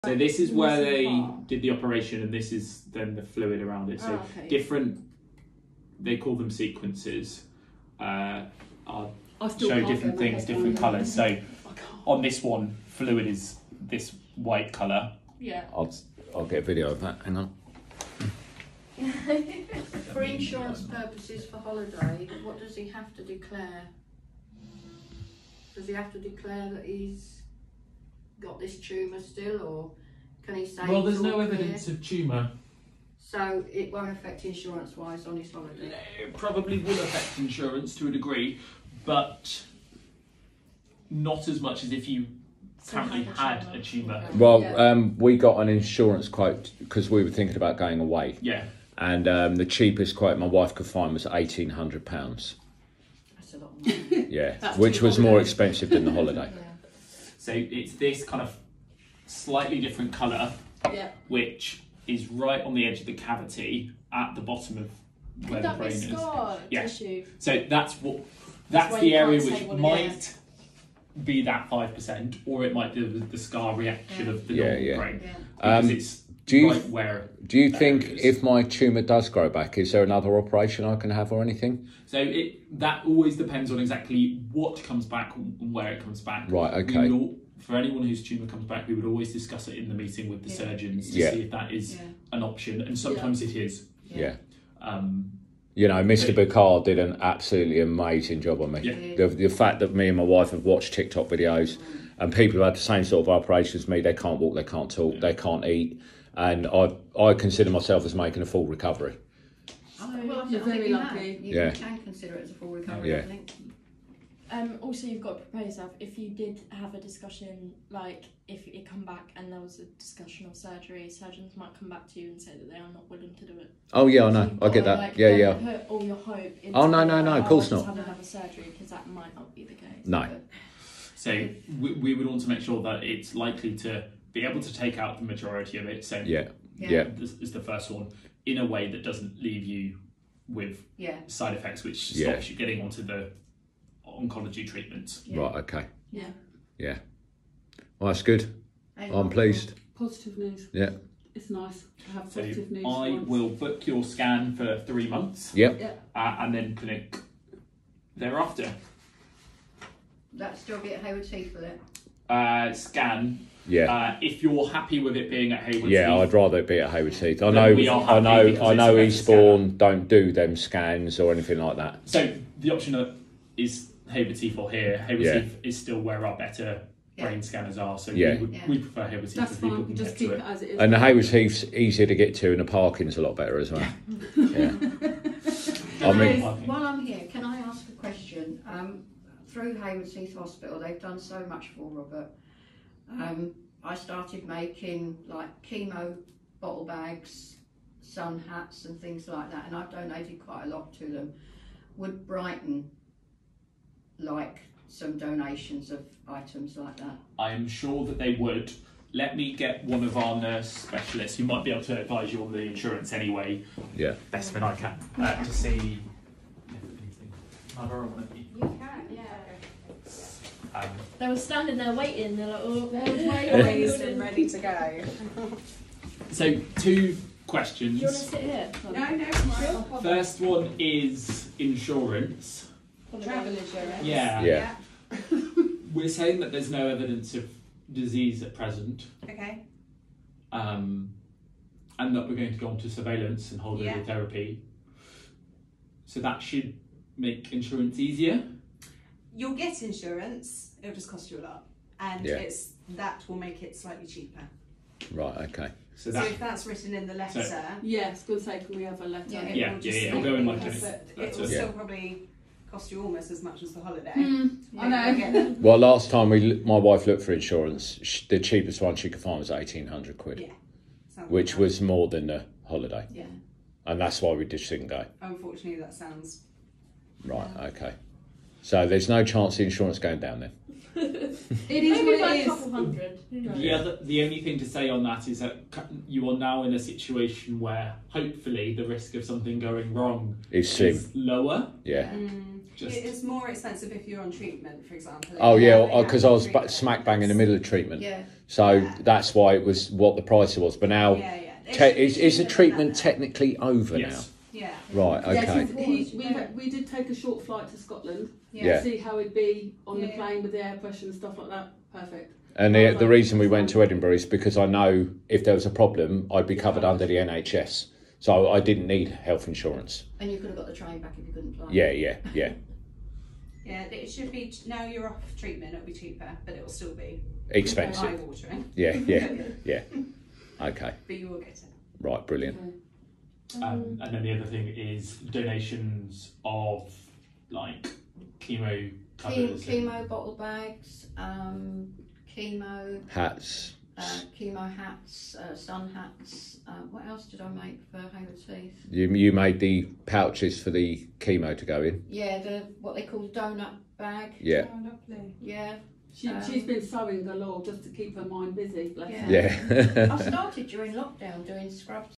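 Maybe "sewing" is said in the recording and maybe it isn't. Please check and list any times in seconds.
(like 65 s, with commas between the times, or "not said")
356 s.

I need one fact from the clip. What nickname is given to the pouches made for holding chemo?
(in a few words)
donut bag.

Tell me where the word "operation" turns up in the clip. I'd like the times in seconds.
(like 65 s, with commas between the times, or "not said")
1 s, 80 s, 103 s.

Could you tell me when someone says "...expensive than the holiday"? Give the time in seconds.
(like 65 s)
55 s.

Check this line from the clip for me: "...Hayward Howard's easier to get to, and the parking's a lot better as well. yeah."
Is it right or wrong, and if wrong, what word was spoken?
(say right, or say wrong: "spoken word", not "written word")
wrong: "Heath", not "Howard".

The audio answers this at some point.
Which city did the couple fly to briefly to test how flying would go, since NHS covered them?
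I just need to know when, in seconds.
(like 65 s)
313 s.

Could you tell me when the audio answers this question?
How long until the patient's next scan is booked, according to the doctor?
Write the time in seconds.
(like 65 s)
154 s.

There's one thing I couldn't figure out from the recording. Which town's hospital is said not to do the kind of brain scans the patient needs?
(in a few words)
Eastbourne.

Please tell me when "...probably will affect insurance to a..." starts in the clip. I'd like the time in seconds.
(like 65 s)
36 s.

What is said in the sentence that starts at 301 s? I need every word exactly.
te- is, is the treatment technically over yes, yeah.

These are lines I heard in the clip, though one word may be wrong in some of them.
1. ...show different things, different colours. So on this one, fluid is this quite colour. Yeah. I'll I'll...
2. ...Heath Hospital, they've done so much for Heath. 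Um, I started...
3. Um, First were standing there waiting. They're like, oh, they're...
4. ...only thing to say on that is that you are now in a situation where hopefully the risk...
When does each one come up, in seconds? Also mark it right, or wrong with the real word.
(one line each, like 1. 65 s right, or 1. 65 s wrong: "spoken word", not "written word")
1. 9 s wrong: "white", not "quite"
2. 190 s wrong: "Robert", not "Heath"
3. 220 s wrong: "They", not "First"
4. 284 s right.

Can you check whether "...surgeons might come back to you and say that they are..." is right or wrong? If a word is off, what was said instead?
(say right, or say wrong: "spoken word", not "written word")
right.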